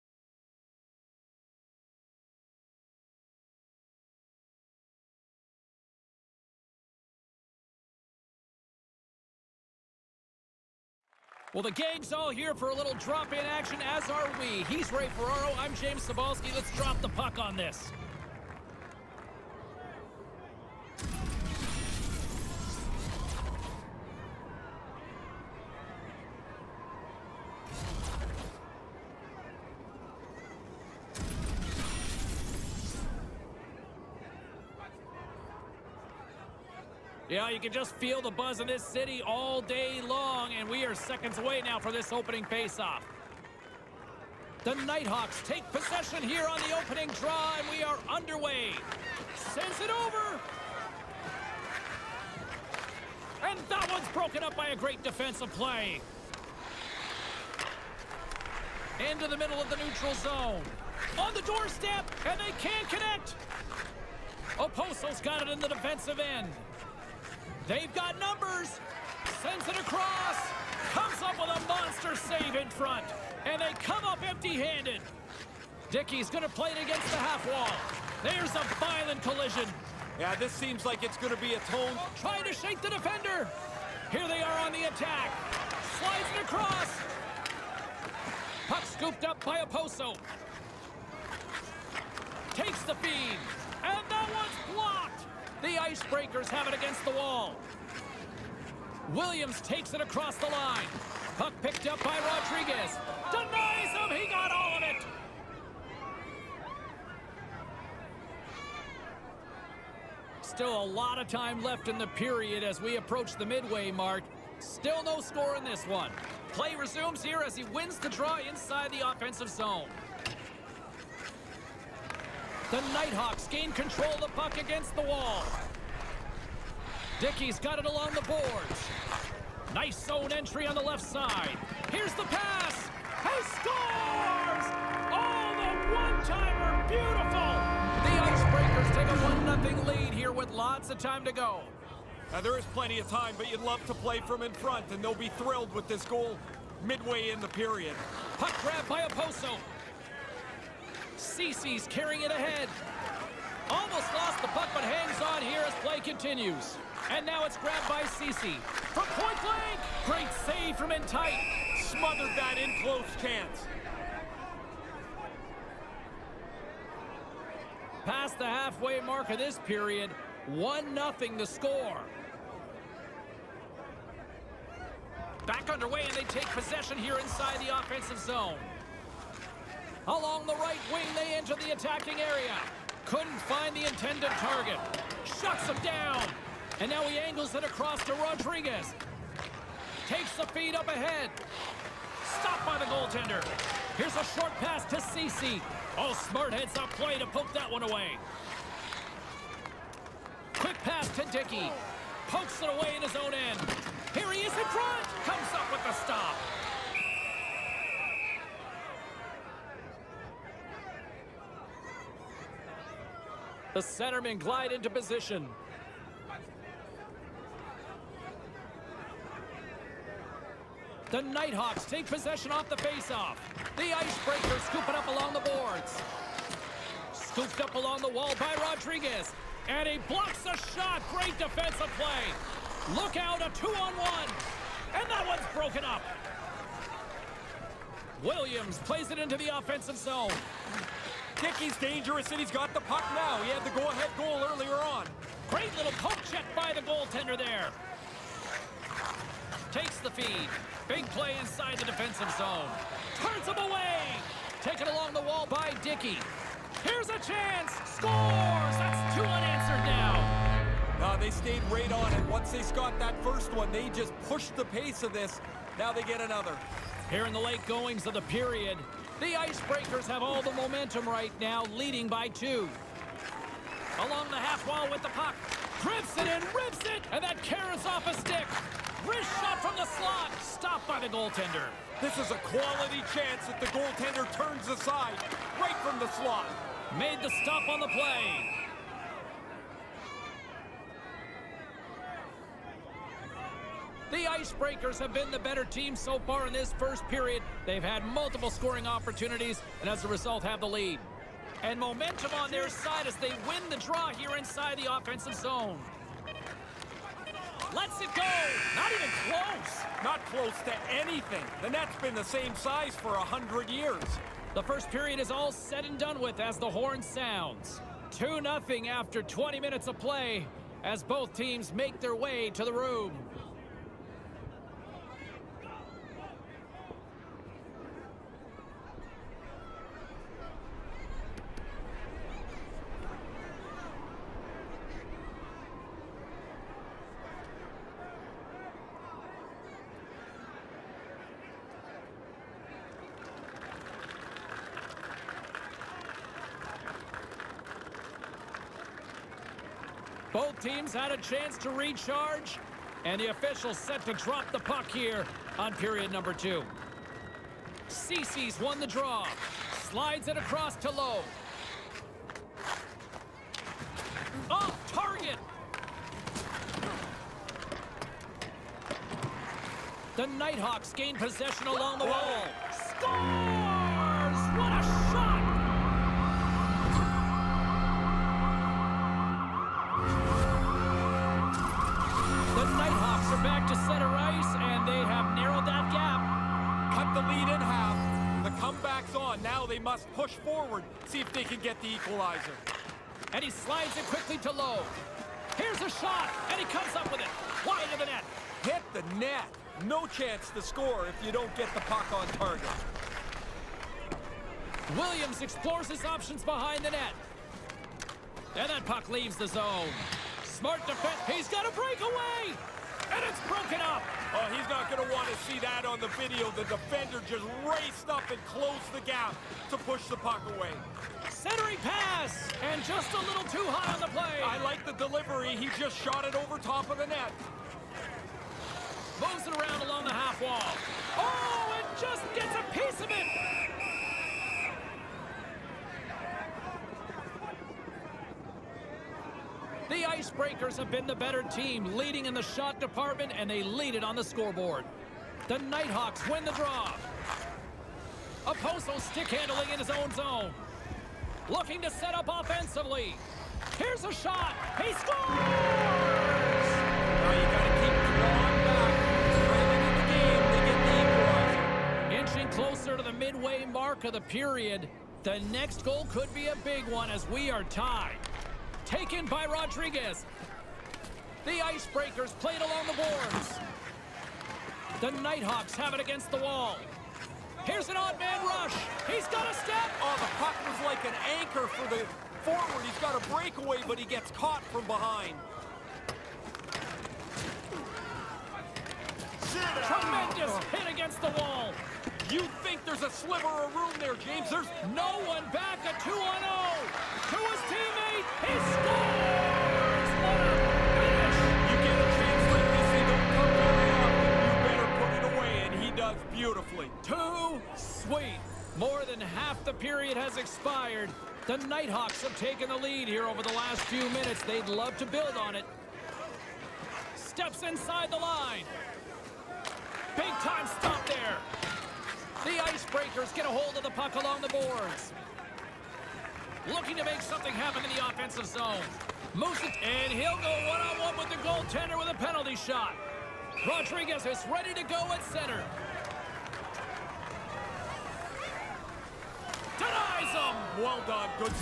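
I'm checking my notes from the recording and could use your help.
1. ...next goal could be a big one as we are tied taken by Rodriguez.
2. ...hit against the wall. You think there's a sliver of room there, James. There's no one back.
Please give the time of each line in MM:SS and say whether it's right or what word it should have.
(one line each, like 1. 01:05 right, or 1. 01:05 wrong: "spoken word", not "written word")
1. 07:45 right
2. 08:10 right.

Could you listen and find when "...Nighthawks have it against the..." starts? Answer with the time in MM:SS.
07:55.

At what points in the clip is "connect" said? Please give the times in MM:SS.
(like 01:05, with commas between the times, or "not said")
01:02.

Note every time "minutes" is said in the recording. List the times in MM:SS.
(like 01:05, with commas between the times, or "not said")
05:19, 08:34.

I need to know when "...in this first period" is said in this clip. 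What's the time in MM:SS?
04:56.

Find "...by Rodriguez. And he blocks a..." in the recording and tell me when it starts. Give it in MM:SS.
03:48.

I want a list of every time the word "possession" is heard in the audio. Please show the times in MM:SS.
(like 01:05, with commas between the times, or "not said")
00:45, 02:56, 03:42, 06:11.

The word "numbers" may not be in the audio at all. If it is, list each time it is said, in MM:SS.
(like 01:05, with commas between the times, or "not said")
01:08, 05:56.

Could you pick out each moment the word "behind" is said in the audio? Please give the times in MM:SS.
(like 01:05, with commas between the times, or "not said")
06:46, 08:04.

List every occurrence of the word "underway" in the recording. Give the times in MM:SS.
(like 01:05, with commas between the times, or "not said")
00:48, 02:55.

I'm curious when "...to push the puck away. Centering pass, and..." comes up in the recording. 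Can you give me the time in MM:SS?
06:59.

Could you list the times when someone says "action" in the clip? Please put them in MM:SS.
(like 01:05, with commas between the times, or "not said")
00:13.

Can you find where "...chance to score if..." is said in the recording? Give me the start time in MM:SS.
06:40.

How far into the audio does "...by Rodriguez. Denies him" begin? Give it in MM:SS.
01:42.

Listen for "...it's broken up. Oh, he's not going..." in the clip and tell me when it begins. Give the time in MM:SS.
06:53.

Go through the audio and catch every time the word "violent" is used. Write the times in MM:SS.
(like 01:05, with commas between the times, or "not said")
01:18.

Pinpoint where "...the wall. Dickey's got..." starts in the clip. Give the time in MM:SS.
02:04.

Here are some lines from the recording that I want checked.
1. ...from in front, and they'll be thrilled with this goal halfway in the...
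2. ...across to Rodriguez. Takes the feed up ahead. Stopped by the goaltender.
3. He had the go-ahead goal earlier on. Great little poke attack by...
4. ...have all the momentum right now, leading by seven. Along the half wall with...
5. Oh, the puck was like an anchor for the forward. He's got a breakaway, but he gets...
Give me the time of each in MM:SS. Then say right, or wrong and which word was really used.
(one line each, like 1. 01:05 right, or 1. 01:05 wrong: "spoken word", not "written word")
1. 02:24 wrong: "midway", not "halfway"
2. 03:07 right
3. 04:03 wrong: "check", not "attack"
4. 04:30 wrong: "two", not "seven"
5. 08:00 right.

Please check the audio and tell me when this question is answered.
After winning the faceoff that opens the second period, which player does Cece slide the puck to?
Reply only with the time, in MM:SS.
06:00.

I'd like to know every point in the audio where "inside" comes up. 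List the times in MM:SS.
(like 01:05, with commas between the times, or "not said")
01:58, 02:57, 04:11, 05:04, 08:37.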